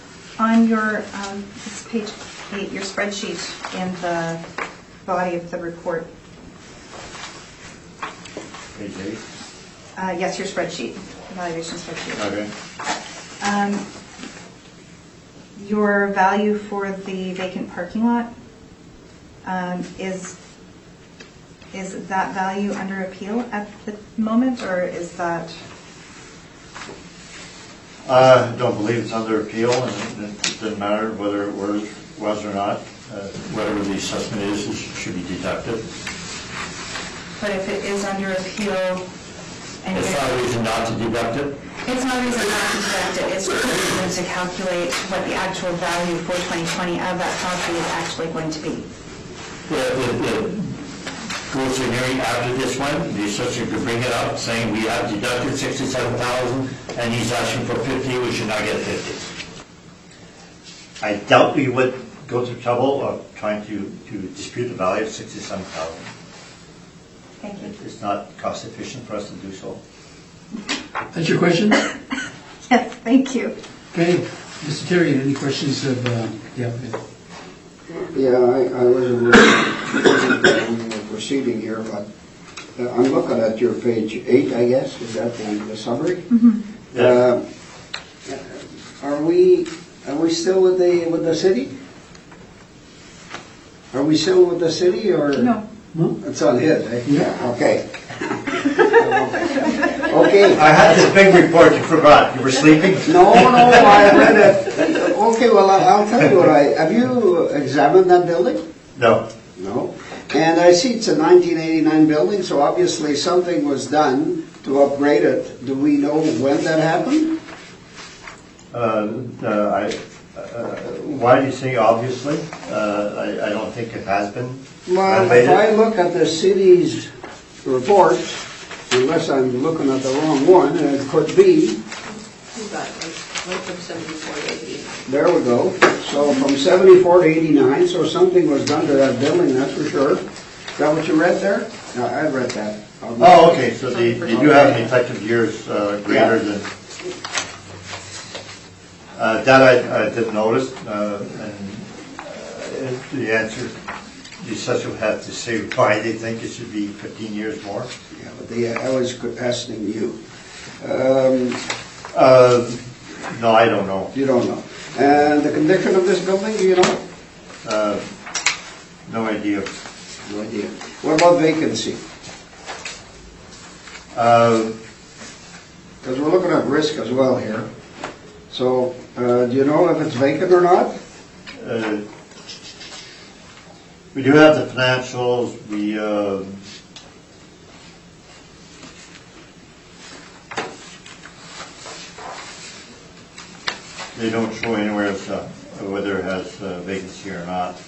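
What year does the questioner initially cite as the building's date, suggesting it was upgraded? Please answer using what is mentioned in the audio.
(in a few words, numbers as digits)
1989.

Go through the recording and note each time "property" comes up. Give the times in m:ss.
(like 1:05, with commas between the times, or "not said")
0:47.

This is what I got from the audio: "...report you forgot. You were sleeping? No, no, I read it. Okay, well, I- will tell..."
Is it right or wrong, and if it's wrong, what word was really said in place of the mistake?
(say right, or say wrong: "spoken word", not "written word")
right.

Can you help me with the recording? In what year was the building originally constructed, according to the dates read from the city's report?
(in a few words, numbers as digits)
1974.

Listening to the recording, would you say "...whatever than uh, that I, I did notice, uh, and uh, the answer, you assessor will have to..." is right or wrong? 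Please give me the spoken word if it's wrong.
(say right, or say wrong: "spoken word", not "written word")
wrong: "greater", not "whatever".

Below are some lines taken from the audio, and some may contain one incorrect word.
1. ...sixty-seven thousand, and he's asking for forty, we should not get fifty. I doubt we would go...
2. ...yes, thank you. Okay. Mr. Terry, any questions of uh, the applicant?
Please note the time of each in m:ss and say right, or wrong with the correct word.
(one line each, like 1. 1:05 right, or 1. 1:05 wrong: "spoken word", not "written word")
1. 0:55 wrong: "fifty", not "forty"
2. 1:11 right.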